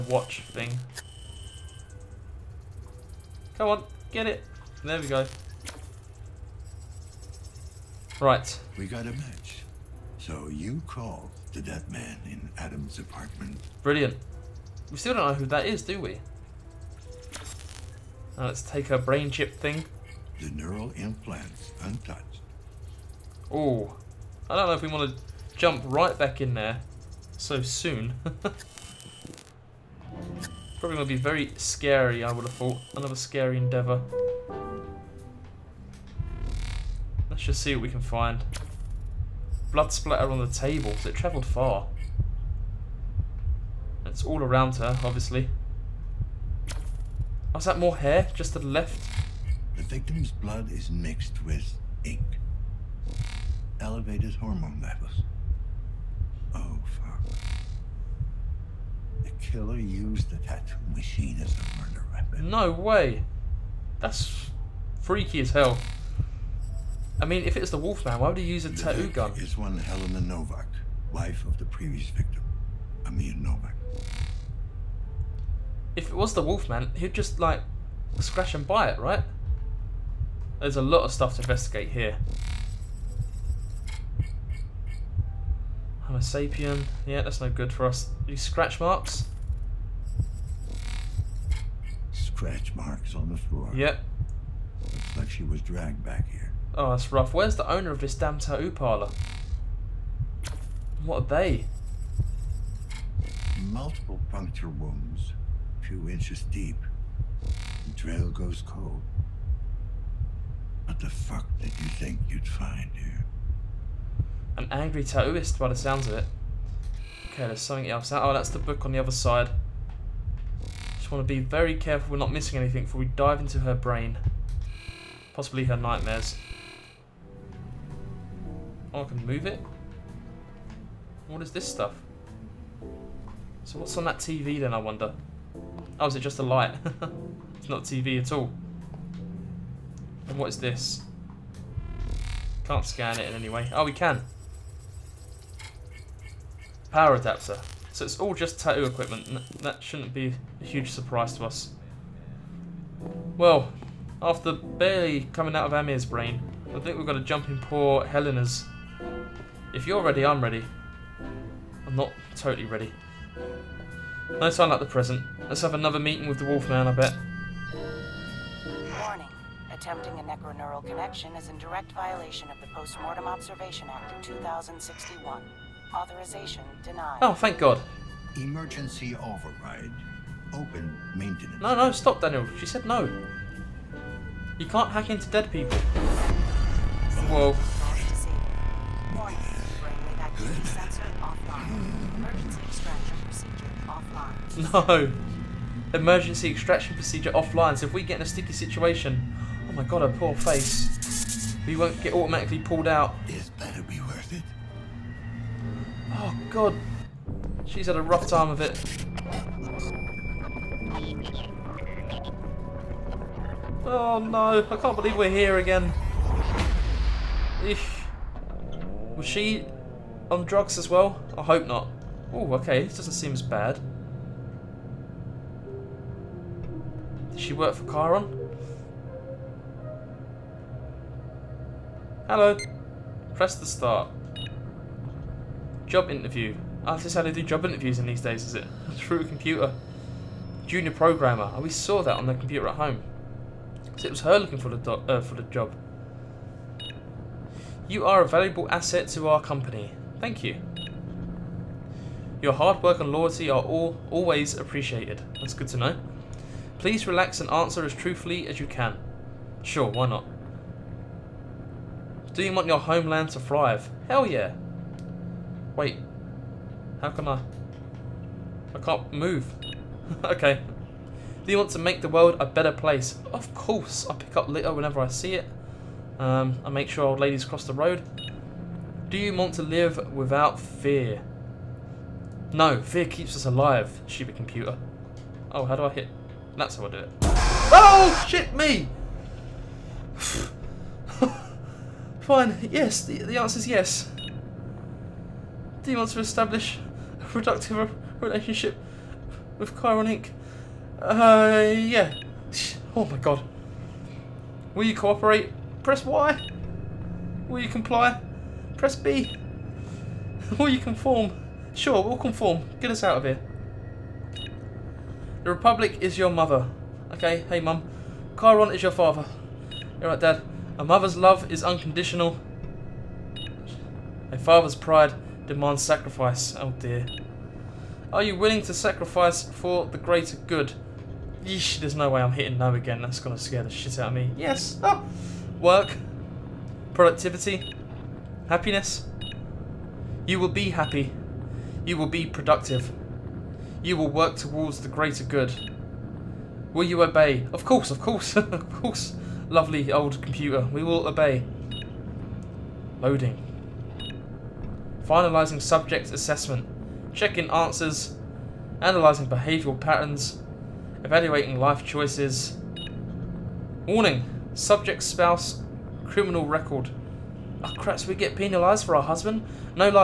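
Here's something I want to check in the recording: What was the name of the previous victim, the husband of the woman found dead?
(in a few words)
Amir Novak.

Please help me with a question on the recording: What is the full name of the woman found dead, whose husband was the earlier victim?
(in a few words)
Helena Novak.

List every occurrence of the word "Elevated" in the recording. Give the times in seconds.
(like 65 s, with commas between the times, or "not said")
53 s.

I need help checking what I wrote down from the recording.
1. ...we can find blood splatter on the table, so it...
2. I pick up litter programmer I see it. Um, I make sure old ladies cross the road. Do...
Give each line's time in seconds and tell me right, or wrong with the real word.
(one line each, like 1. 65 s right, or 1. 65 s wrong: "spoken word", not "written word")
1. 37 s right
2. 274 s wrong: "whenever", not "programmer".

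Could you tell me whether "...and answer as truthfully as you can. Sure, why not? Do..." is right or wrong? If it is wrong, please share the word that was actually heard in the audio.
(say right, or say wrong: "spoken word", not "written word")
right.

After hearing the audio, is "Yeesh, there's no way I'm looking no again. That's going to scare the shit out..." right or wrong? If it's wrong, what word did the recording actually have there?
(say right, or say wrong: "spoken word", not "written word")
wrong: "hitting", not "looking".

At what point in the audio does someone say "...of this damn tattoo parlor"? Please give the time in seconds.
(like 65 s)
97 s.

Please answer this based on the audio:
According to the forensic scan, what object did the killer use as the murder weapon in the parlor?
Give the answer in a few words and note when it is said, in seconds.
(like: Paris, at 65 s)
Tattoo machine, at 60 s.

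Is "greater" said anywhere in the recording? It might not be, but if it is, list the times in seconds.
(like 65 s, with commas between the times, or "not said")
329 s, 344 s.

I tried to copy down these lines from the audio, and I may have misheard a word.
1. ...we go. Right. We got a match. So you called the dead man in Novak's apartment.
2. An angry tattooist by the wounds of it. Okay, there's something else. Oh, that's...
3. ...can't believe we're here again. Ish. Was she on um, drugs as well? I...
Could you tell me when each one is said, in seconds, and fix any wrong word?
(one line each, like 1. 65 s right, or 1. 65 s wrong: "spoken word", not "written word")
1. 4 s wrong: "Adam", not "Novak"
2. 114 s wrong: "sounds", not "wounds"
3. 214 s right.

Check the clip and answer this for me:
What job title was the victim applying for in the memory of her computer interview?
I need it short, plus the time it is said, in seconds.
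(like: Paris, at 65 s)
Junior programmer, at 240 s.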